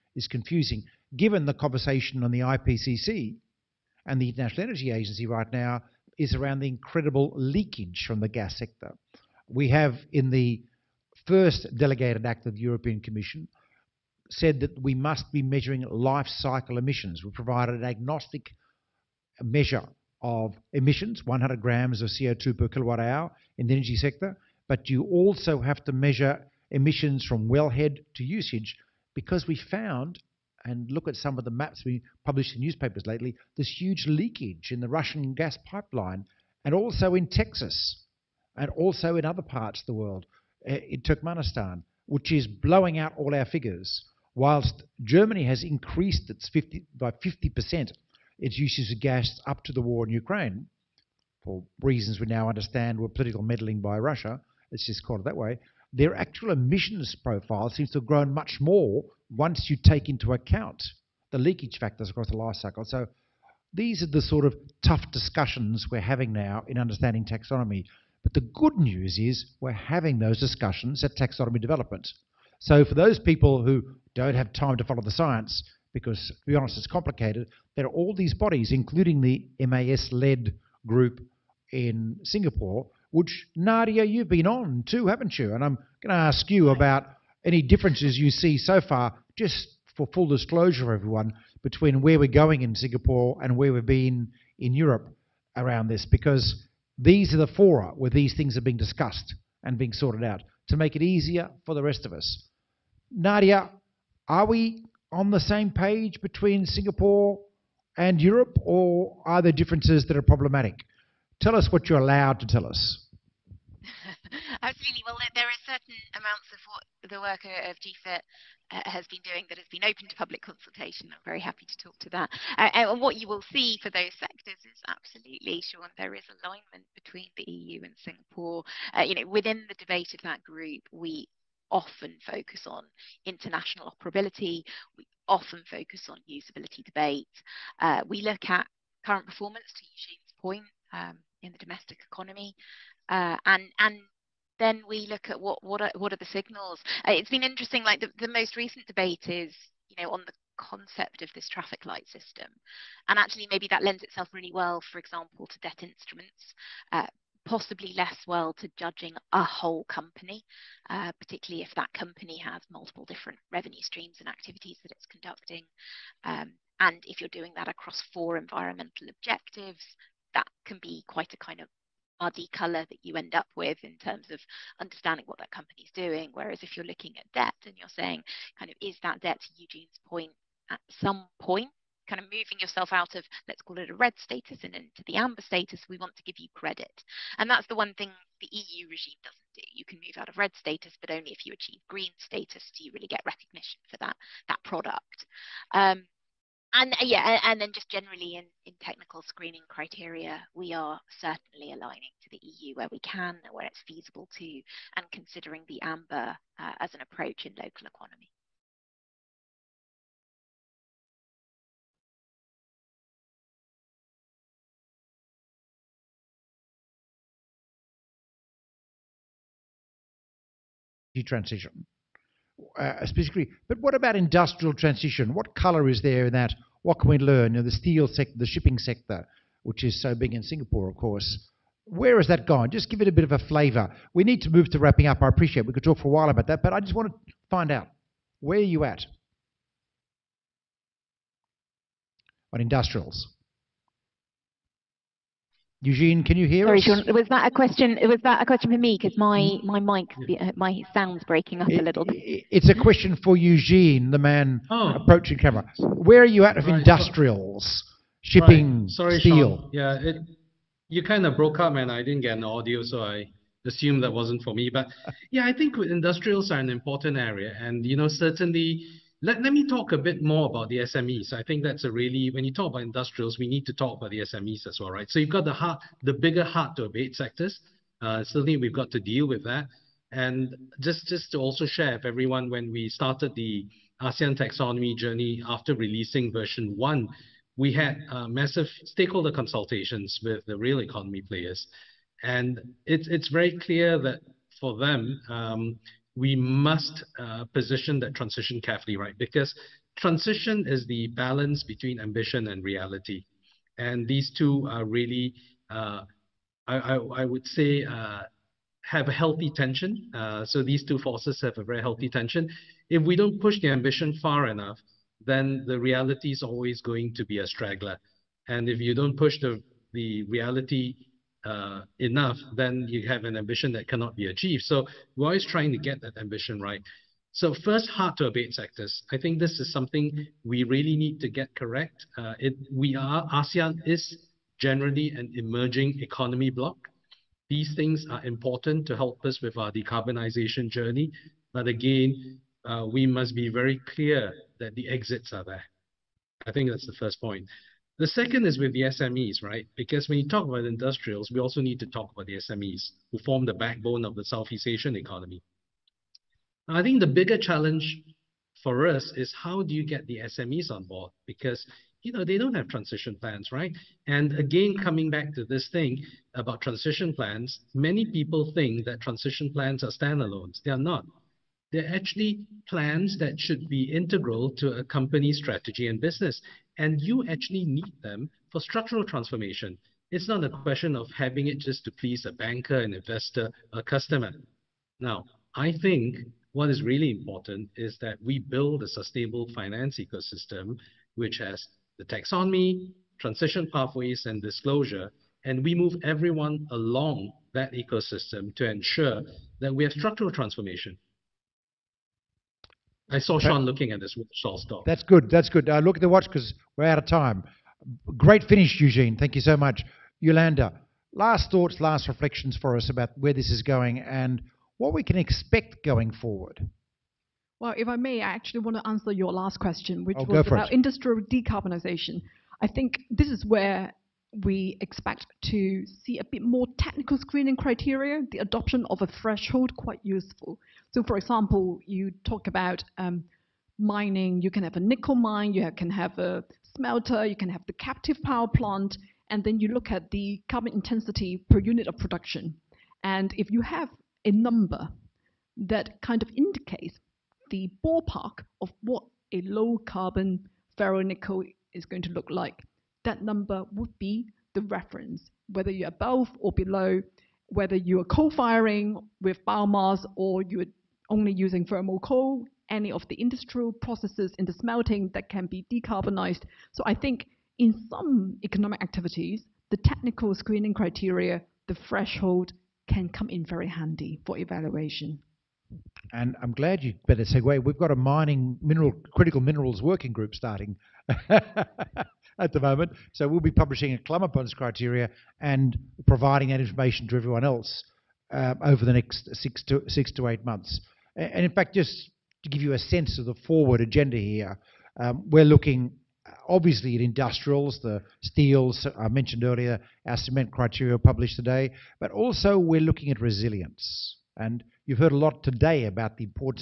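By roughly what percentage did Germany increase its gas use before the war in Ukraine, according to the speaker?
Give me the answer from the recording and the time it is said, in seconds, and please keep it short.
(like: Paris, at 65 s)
50%, at 46 s.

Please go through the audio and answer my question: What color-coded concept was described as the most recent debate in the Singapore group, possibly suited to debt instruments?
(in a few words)
Traffic light system.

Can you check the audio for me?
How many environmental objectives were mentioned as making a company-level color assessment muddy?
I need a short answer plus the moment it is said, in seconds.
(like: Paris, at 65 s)
4, at 168 s.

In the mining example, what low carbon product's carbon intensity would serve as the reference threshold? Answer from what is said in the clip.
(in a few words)
Ferro-nickel.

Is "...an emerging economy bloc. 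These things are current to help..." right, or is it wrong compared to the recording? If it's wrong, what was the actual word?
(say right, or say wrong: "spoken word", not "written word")
wrong: "important", not "current".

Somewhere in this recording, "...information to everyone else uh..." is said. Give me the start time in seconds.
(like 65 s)
486 s.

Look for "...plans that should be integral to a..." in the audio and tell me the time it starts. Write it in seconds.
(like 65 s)
372 s.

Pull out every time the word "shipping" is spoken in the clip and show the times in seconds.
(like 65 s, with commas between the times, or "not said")
228 s, 258 s.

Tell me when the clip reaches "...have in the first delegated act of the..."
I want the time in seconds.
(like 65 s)
9 s.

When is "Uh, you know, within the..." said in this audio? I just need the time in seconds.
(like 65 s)
128 s.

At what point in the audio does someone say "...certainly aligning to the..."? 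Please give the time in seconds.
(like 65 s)
201 s.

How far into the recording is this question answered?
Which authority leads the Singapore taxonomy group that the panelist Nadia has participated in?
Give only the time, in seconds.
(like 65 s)
79 s.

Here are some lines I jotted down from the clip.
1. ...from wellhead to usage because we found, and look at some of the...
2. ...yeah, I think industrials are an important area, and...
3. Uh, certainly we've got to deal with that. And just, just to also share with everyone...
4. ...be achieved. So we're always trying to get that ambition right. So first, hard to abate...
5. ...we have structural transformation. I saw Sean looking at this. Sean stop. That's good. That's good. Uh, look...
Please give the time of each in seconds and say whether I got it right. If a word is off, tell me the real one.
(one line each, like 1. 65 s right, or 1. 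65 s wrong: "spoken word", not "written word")
1. 27 s right
2. 265 s right
3. 278 s right
4. 324 s right
5. 399 s right.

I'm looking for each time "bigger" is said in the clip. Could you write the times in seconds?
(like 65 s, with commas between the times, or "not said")
276 s, 357 s.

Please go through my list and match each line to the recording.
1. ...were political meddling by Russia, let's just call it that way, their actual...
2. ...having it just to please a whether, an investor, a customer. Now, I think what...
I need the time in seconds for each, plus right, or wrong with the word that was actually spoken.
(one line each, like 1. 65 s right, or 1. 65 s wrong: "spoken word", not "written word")
1. 52 s right
2. 381 s wrong: "banker", not "whether".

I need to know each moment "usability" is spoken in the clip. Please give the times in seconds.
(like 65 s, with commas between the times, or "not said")
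136 s.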